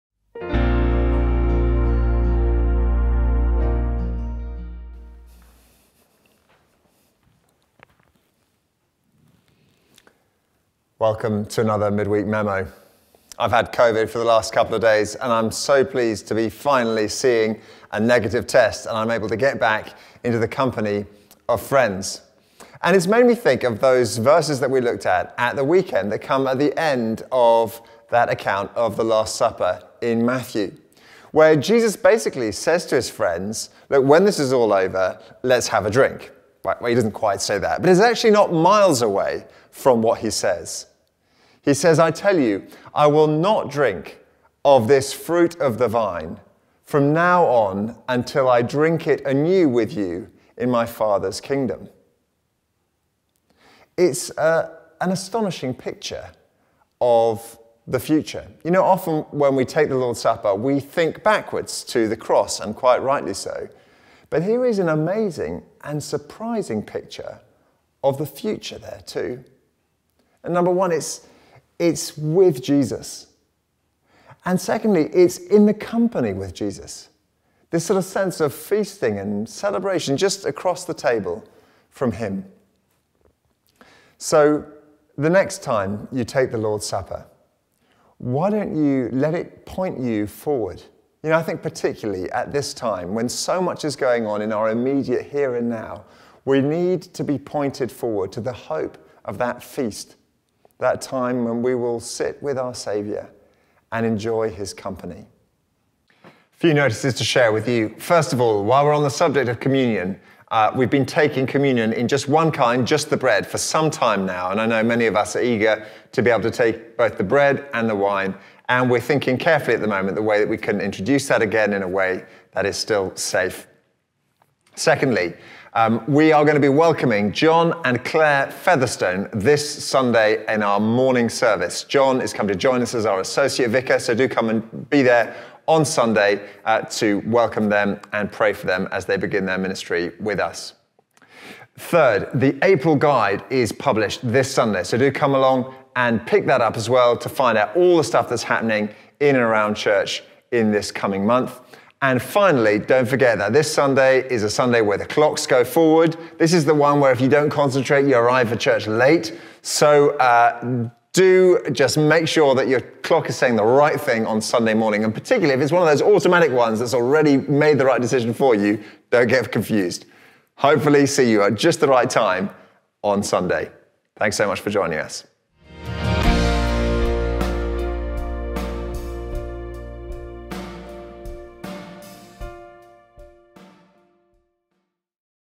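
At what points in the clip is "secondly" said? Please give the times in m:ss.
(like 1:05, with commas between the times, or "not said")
1:14, 2:04.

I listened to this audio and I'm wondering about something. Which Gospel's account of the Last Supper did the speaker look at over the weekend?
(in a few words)
Matthew.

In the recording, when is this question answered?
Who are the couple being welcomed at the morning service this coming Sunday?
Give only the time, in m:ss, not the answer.
2:07.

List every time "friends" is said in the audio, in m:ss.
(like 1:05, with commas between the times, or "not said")
0:21, 0:33.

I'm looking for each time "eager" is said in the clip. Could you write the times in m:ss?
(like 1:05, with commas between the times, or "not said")
1:55.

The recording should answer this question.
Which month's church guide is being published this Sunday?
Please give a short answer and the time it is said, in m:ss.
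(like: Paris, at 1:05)
April, at 2:22.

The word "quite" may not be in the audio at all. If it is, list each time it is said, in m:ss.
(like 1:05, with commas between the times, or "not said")
0:37, 1:02.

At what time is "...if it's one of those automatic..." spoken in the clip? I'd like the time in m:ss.
2:45.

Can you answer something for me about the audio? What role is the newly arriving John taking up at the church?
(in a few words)
Associate vicar.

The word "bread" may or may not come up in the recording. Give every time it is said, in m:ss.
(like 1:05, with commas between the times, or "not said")
1:53, 1:57.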